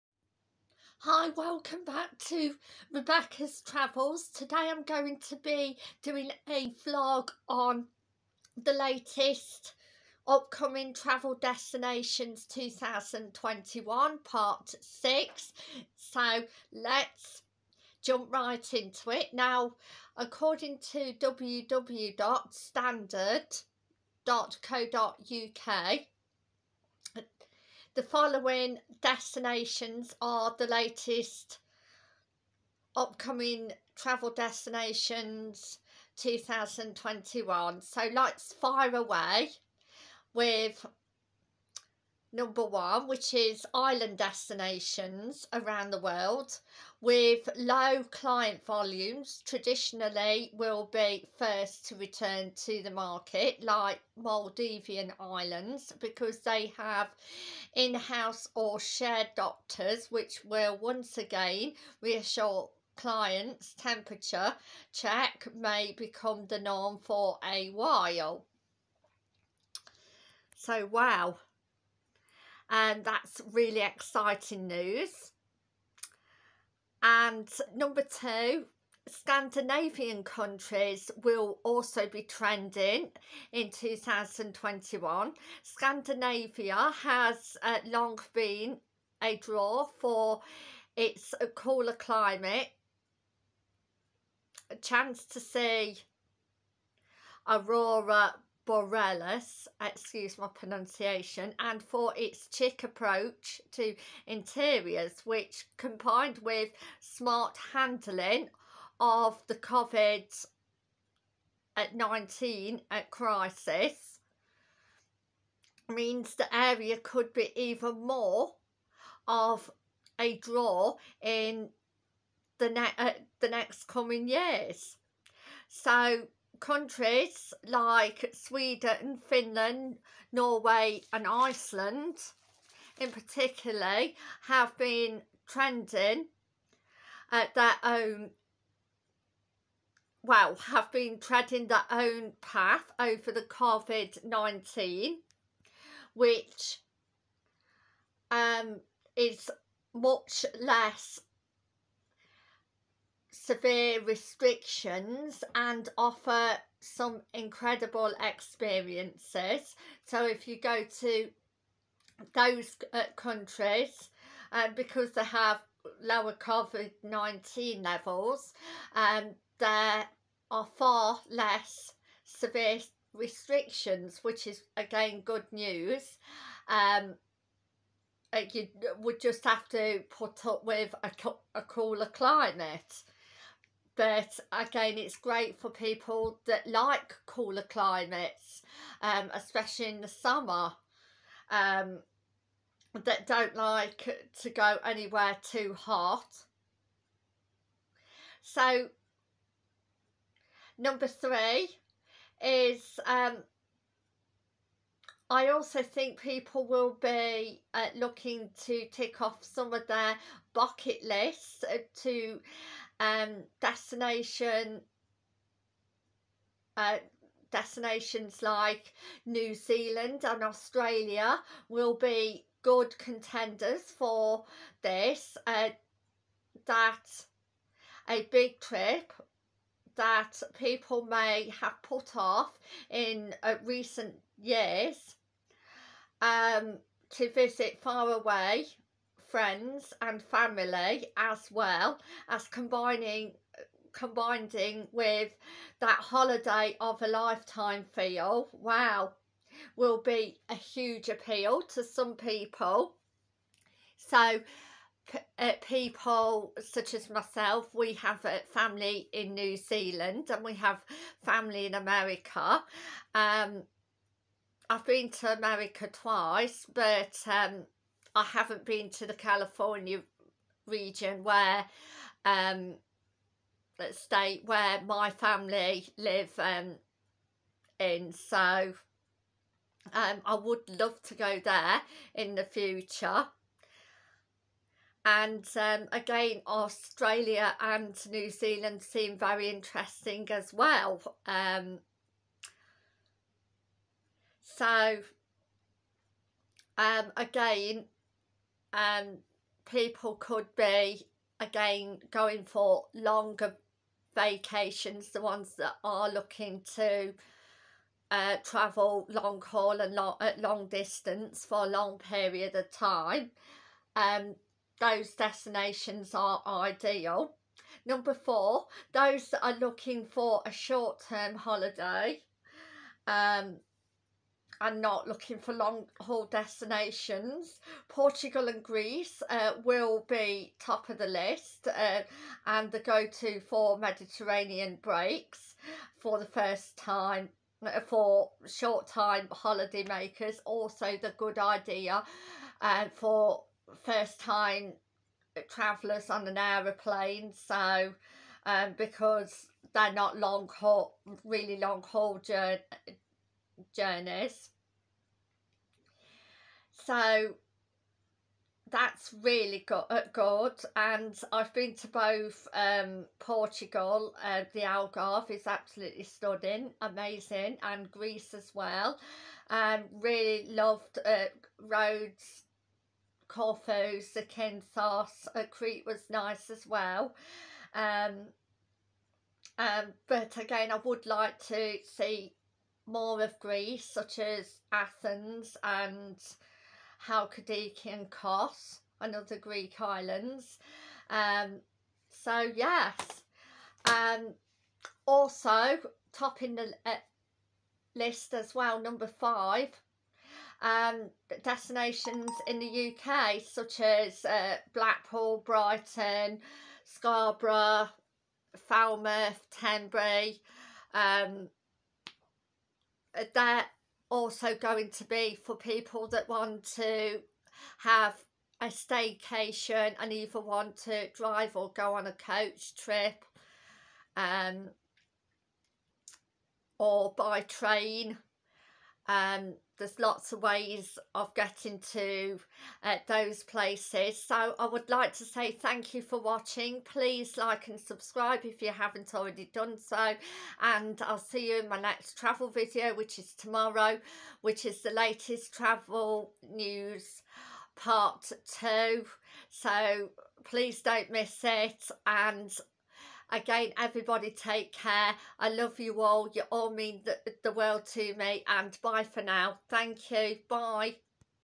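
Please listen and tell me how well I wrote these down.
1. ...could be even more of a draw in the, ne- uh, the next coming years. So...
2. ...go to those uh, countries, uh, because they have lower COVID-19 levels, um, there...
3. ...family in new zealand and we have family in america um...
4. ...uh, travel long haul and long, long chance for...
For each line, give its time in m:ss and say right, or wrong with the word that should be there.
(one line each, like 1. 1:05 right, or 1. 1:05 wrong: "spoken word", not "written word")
1. 1:56 right
2. 2:40 right
3. 4:18 right
4. 5:08 wrong: "distance", not "chance".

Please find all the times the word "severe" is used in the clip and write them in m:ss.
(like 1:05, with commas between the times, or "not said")
2:33, 2:52.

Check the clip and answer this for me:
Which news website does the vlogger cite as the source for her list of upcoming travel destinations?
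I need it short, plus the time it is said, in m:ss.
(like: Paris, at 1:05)
www.standard.co.uk, at 0:21.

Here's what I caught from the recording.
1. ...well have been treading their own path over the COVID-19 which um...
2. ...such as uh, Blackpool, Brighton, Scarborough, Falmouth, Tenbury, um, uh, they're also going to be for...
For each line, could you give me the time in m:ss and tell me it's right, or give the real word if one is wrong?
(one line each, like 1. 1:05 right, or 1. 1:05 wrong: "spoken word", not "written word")
1. 2:20 right
2. 6:43 right.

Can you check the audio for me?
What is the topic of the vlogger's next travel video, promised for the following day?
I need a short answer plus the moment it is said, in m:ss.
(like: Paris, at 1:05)
Latest travel news part 2, at 7:24.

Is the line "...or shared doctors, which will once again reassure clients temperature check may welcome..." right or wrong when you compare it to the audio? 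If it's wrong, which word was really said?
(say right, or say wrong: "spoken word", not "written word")
wrong: "become", not "welcome".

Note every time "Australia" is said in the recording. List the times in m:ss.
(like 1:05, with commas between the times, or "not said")
3:40, 4:46.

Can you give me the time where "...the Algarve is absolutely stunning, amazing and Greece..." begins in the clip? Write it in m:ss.
6:04.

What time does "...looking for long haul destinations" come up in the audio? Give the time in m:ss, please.
5:25.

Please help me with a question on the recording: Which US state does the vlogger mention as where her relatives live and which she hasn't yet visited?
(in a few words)
California.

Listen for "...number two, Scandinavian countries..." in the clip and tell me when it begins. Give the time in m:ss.
1:17.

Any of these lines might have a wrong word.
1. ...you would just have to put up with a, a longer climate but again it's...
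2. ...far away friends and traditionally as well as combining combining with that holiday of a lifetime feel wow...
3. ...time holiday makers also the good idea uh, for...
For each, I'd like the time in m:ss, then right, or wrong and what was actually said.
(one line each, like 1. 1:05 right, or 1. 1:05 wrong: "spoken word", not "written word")
1. 2:58 wrong: "cooler", not "longer"
2. 3:57 wrong: "family", not "traditionally"
3. 5:38 right.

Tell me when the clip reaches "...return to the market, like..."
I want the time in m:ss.
0:51.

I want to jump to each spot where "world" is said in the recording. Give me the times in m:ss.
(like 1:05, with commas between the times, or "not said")
0:45, 7:37.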